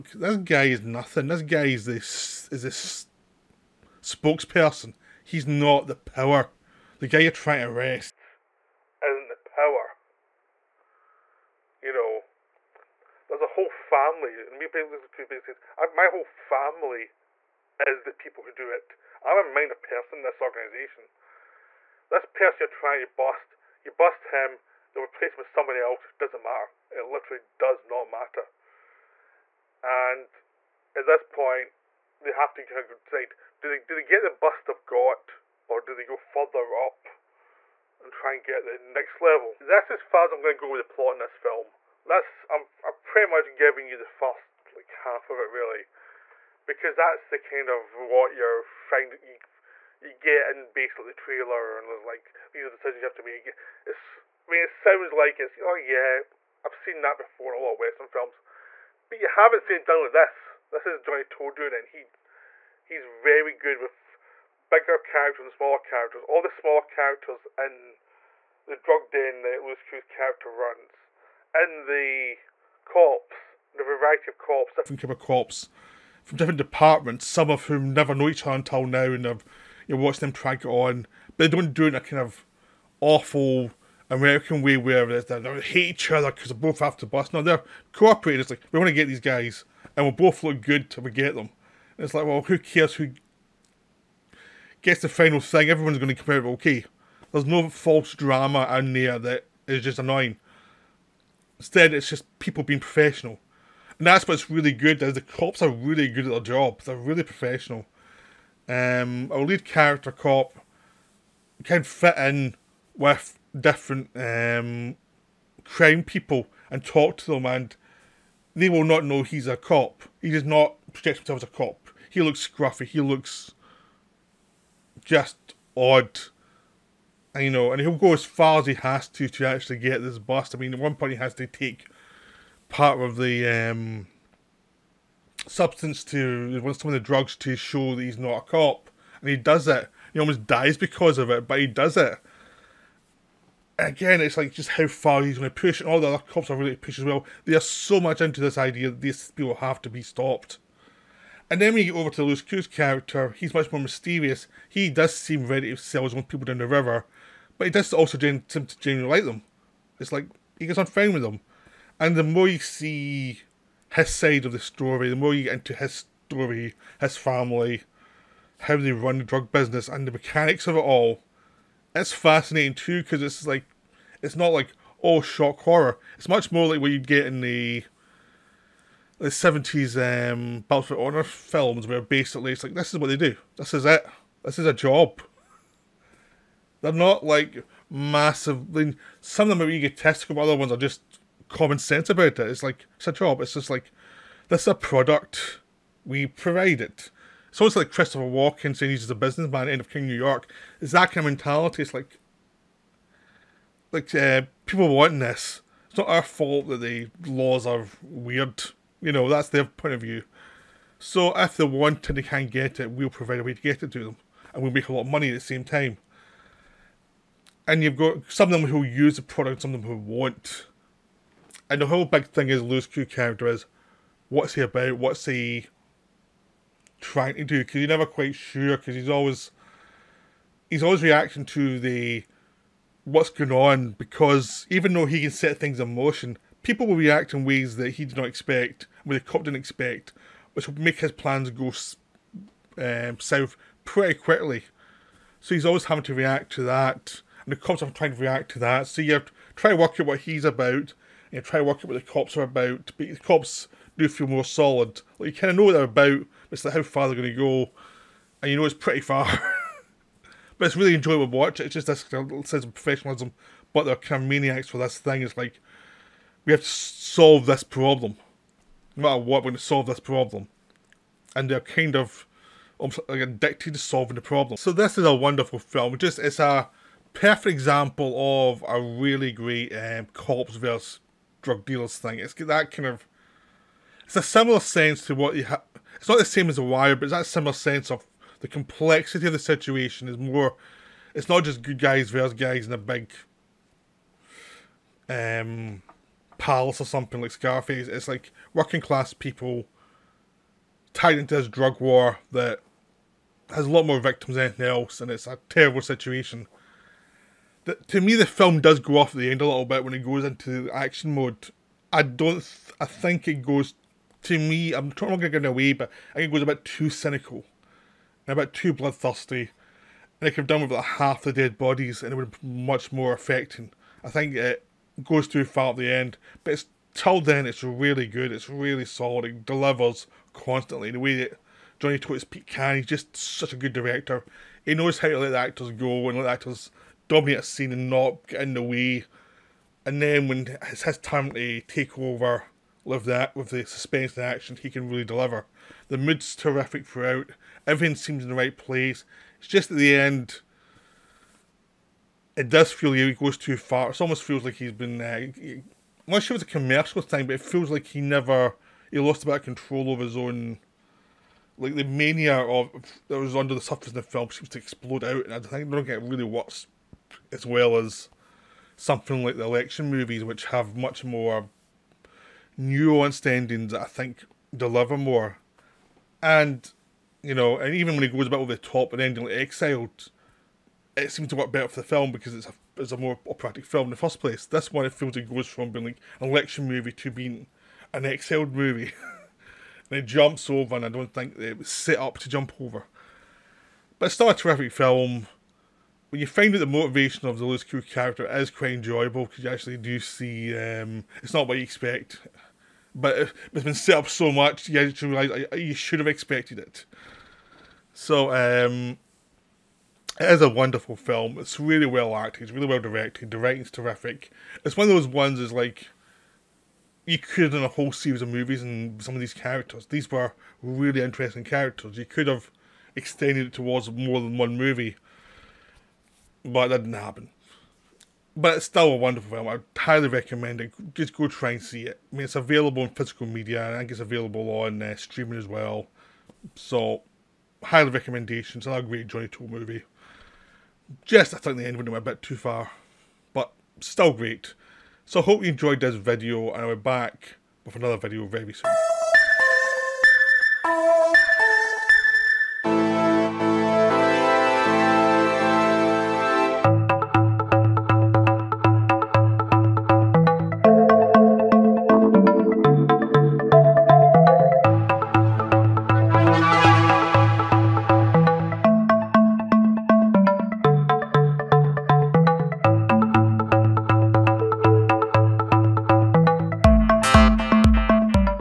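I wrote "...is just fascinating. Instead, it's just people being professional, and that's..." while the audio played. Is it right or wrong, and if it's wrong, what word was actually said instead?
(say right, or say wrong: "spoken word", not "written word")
wrong: "annoying", not "fascinating".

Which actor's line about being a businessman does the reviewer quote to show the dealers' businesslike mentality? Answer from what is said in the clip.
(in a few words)
Christopher Walken.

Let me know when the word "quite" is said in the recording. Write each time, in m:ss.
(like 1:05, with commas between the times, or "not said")
3:48, 6:38.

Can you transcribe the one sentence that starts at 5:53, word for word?
It almost feels like he's been.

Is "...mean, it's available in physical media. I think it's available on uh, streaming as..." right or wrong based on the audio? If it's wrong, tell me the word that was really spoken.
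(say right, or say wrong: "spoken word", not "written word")
right.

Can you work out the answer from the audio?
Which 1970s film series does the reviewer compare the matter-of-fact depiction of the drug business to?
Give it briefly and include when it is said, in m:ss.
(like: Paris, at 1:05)
Battle for Honor, at 3:00.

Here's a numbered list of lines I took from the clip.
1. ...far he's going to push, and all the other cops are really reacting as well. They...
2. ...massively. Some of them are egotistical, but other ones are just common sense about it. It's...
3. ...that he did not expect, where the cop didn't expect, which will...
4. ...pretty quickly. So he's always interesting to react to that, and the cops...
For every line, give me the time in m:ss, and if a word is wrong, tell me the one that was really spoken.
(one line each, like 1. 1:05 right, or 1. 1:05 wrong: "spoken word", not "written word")
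1. 2:24 wrong: "pushing", not "reacting"
2. 3:07 right
3. 3:57 right
4. 4:03 wrong: "having", not "interesting".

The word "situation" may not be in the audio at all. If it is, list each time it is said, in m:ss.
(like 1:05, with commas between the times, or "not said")
4:49, 5:05.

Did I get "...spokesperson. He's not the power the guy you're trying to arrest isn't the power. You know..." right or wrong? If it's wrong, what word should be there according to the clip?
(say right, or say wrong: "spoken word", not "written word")
right.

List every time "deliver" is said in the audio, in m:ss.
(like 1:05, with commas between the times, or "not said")
5:29, 5:45, 6:14.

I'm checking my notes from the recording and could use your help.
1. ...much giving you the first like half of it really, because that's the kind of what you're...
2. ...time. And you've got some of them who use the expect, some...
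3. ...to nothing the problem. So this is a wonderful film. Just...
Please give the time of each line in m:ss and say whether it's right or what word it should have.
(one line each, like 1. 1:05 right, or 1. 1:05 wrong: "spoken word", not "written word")
1. 0:43 right
2. 3:35 wrong: "product", not "expect"
3. 4:33 wrong: "solving", not "nothing".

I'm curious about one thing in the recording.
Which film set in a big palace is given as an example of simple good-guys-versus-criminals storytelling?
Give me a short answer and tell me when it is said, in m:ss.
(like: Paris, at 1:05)
Scarface, at 4:57.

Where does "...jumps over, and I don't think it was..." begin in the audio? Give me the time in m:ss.
6:30.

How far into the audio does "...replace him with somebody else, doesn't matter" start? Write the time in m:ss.
0:25.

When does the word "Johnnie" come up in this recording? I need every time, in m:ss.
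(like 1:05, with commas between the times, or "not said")
1:00, 5:31, 7:19.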